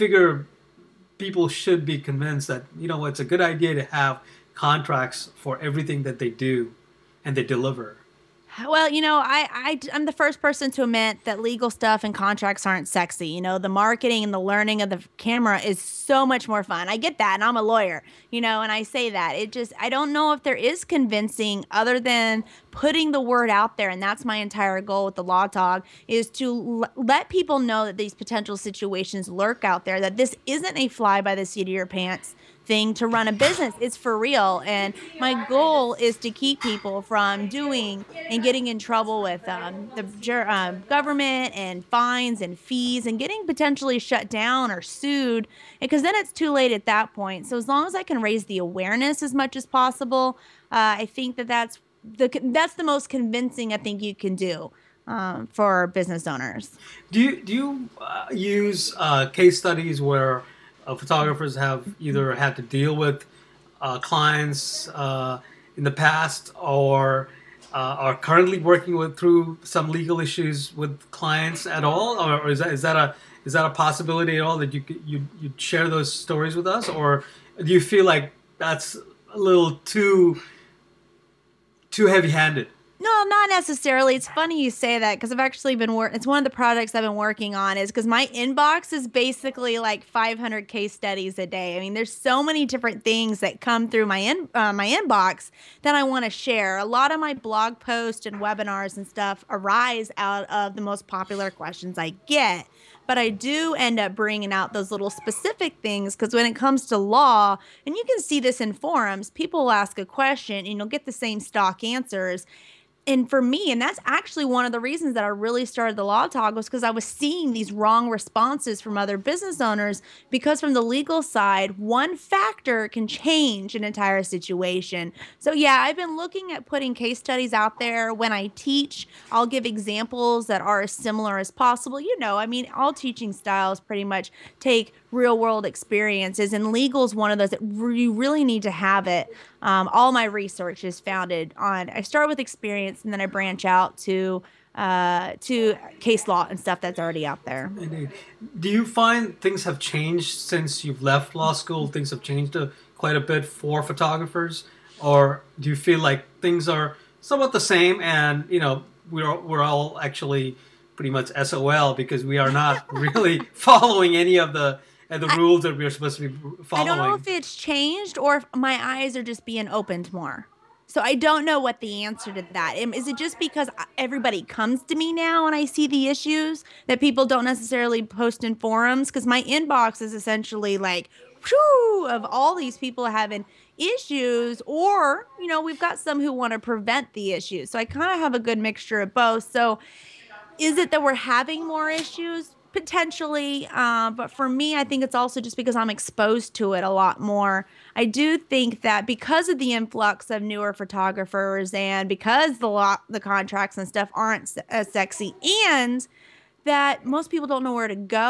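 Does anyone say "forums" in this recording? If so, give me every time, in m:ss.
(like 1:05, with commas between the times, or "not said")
1:48, 2:58.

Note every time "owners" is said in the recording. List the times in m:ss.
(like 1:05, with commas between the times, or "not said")
0:56, 1:59.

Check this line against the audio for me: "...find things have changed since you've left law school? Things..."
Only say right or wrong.
right.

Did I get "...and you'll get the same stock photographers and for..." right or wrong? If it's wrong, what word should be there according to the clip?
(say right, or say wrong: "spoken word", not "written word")
wrong: "answers", not "photographers".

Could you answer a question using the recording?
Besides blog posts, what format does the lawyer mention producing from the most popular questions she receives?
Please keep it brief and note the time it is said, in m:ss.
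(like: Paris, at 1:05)
Webinars, at 1:38.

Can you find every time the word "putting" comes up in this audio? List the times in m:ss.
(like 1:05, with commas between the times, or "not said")
0:22, 2:06.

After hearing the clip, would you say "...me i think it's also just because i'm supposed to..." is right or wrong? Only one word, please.
wrong.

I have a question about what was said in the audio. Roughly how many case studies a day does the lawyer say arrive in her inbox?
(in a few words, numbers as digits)
500.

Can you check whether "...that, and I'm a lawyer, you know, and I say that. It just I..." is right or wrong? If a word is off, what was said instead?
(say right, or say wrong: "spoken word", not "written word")
right.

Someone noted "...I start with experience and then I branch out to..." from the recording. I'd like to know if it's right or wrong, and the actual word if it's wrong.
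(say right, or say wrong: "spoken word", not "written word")
right.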